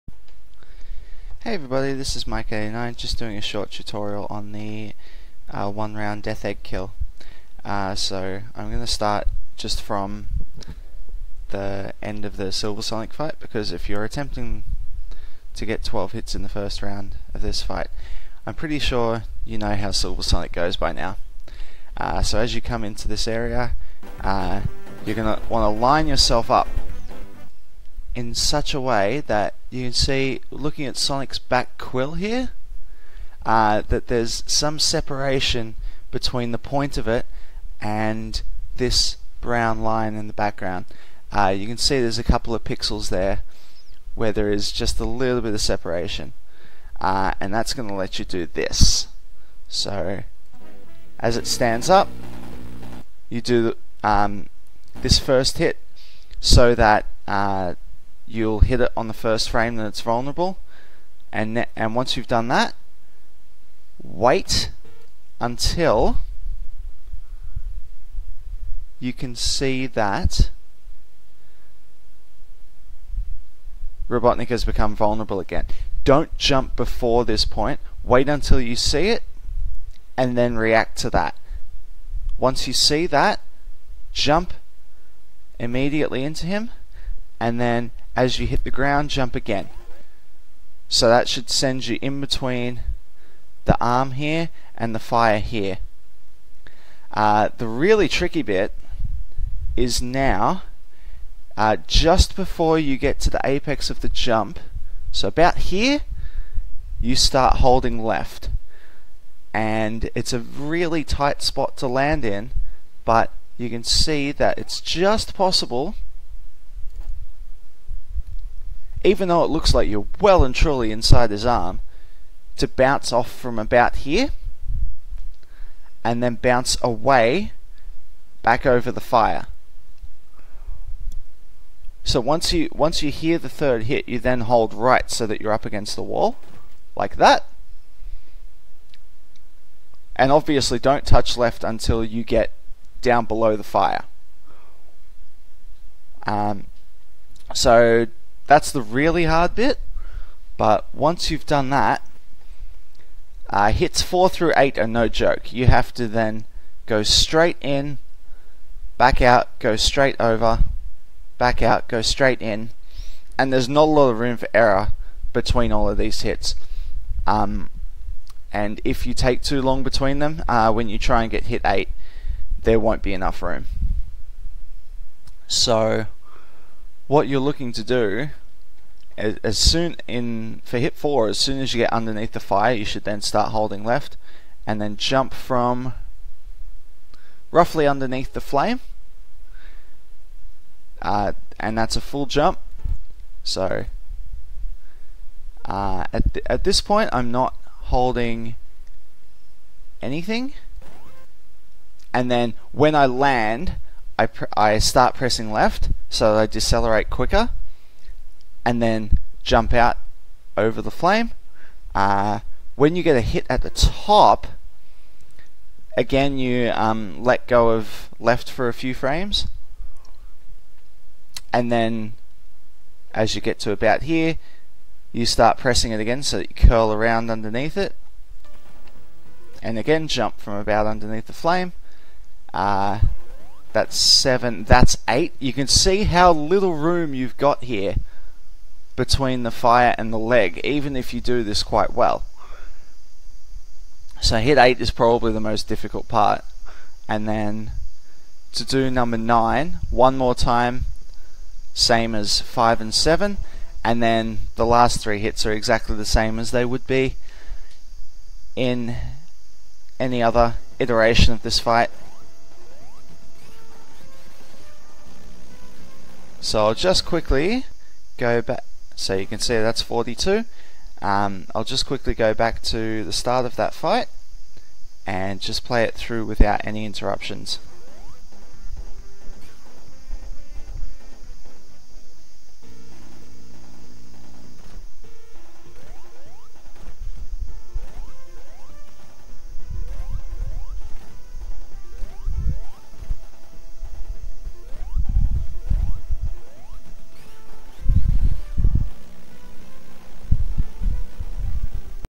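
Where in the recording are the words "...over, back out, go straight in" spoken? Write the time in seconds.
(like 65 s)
160 s.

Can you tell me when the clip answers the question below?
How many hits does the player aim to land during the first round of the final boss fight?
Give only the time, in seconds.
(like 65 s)
15 s.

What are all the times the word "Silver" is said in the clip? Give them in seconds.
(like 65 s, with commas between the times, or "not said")
12 s, 19 s.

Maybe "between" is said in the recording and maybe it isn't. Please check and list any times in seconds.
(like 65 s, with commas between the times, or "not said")
36 s, 92 s, 165 s, 169 s, 238 s.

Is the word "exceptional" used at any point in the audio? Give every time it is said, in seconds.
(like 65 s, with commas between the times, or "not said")
not said.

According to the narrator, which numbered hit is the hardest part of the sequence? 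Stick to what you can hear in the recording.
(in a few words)
hit 8.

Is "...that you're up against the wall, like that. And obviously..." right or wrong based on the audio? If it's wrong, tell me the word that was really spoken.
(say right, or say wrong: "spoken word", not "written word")
right.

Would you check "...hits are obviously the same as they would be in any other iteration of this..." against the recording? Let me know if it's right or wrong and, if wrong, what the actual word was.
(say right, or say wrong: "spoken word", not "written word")
wrong: "exactly", not "obviously".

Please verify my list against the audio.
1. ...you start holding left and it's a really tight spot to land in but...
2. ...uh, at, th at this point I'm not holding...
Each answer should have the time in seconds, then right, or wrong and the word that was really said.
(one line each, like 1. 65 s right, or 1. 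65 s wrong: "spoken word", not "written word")
1. 106 s right
2. 195 s right.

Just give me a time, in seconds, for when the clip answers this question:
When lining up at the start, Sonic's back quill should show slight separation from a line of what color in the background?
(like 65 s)
39 s.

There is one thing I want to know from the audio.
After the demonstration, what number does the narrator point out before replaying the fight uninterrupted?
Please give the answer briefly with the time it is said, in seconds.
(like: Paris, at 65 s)
42, at 269 s.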